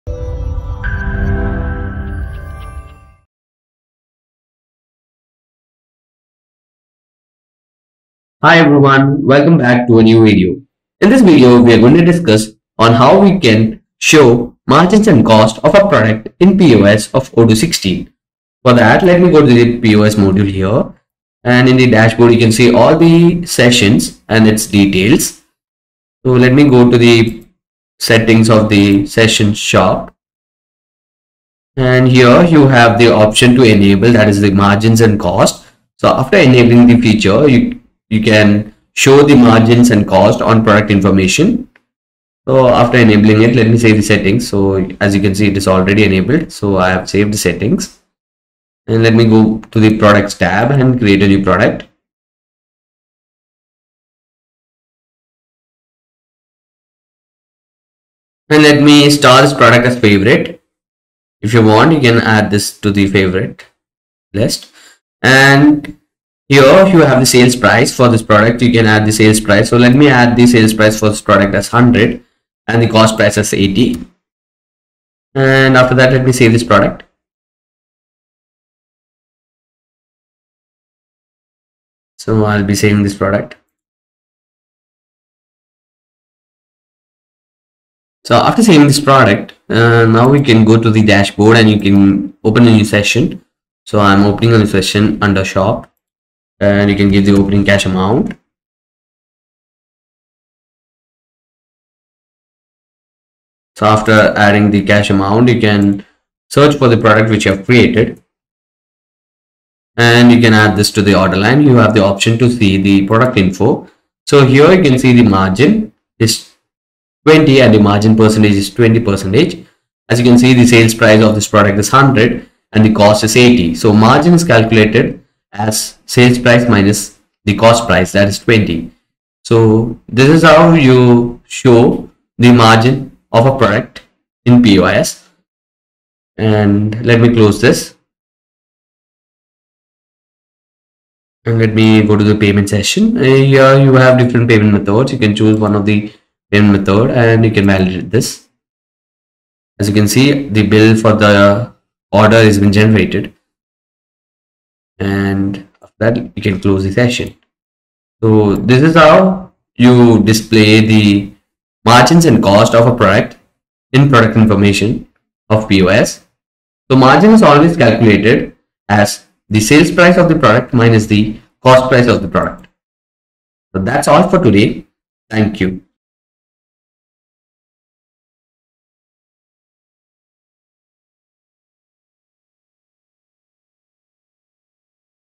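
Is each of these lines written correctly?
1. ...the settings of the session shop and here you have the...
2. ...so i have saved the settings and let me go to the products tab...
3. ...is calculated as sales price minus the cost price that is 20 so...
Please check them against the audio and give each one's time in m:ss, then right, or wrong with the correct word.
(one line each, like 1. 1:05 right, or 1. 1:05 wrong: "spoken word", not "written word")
1. 0:26 right
2. 0:46 right
3. 2:04 right.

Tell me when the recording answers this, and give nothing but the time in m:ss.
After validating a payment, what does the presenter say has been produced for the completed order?
2:30.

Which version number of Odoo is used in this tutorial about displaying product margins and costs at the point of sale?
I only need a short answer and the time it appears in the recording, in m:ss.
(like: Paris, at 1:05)
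16, at 0:17.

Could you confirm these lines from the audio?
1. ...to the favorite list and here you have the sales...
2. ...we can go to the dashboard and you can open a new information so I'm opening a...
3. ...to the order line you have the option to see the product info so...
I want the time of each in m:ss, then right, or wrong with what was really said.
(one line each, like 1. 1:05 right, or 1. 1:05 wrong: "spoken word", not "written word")
1. 1:02 right
2. 1:30 wrong: "session", not "information"
3. 1:50 right.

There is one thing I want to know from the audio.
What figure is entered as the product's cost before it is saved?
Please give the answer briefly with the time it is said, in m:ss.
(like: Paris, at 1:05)
80, at 1:12.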